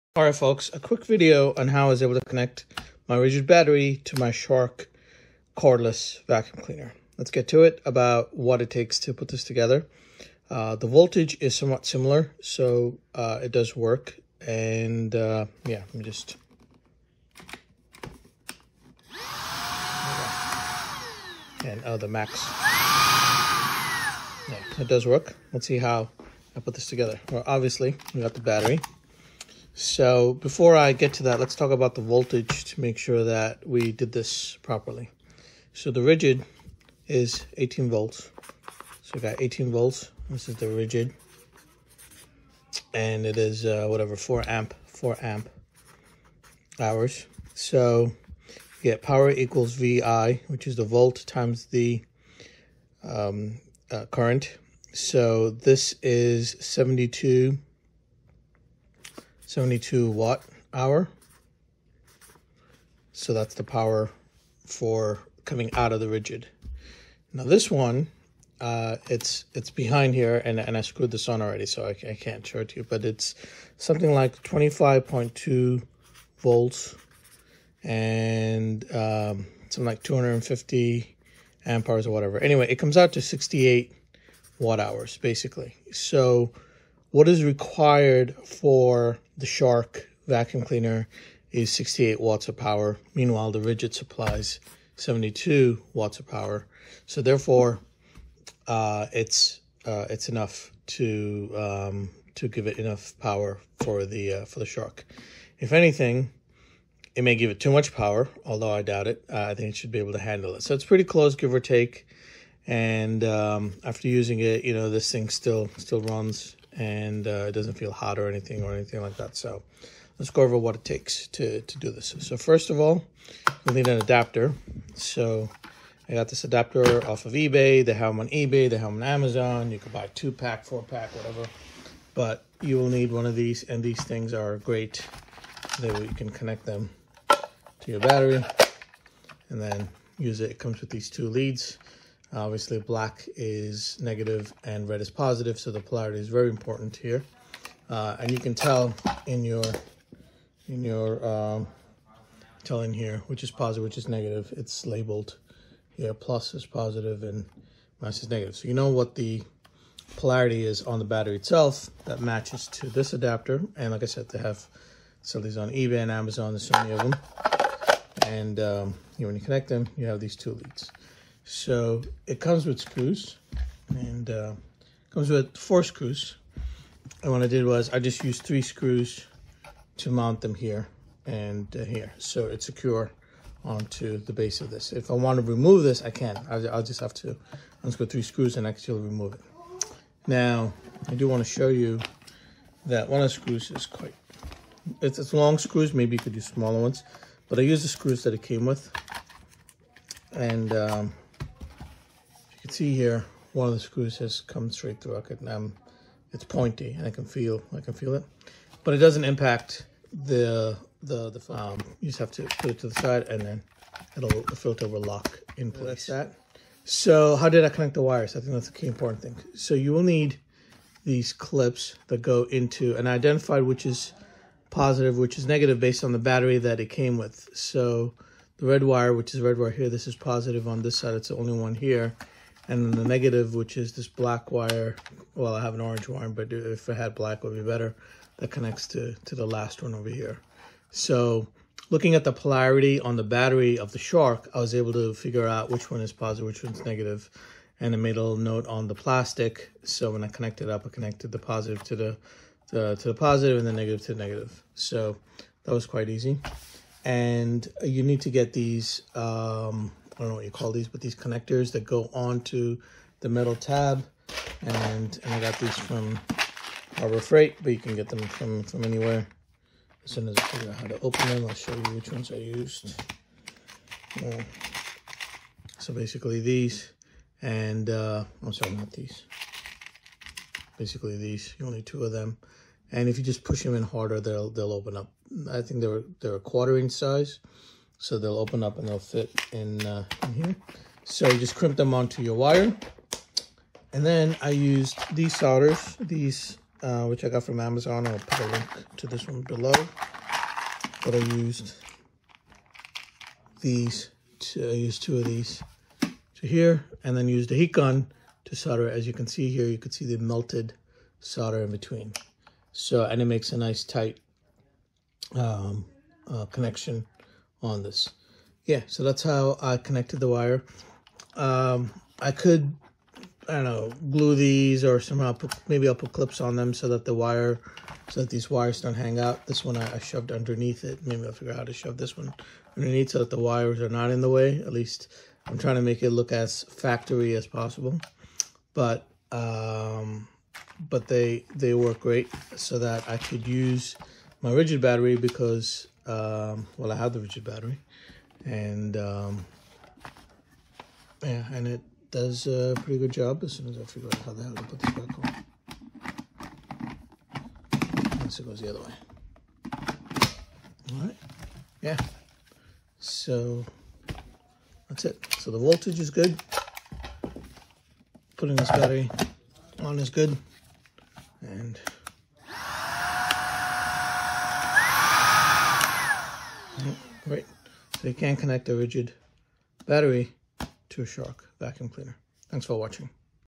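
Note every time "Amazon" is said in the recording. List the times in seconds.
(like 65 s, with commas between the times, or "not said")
129 s, 166 s, 297 s.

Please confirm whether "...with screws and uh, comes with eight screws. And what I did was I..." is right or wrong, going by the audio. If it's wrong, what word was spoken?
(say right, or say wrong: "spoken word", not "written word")
wrong: "four", not "eight".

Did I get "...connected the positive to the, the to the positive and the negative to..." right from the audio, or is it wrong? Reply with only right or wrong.
right.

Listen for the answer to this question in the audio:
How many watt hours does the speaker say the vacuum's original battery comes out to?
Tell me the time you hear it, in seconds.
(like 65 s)
83 s.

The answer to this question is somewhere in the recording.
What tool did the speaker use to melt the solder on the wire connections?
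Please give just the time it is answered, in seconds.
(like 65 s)
307 s.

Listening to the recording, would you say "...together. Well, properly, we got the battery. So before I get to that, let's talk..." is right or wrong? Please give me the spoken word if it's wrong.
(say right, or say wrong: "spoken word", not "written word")
wrong: "obviously", not "properly".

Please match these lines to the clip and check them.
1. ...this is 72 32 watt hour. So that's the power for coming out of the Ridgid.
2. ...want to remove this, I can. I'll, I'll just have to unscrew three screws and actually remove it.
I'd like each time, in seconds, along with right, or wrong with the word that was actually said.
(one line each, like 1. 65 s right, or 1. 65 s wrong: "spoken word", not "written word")
1. 55 s wrong: "72", not "32"
2. 185 s right.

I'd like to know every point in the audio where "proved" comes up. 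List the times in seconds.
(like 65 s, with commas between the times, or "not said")
not said.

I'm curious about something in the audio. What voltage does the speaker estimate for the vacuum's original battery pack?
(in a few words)
25.2 volts.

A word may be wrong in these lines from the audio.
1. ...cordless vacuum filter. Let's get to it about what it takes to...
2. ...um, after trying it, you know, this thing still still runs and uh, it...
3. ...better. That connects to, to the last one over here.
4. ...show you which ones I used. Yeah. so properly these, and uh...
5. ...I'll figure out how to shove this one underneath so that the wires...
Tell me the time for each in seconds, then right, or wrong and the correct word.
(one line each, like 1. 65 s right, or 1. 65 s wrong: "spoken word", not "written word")
1. 5 s wrong: "cleaner", not "filter"
2. 113 s wrong: "using", not "trying"
3. 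237 s right
4. 271 s wrong: "basically", not "properly"
5. 331 s right.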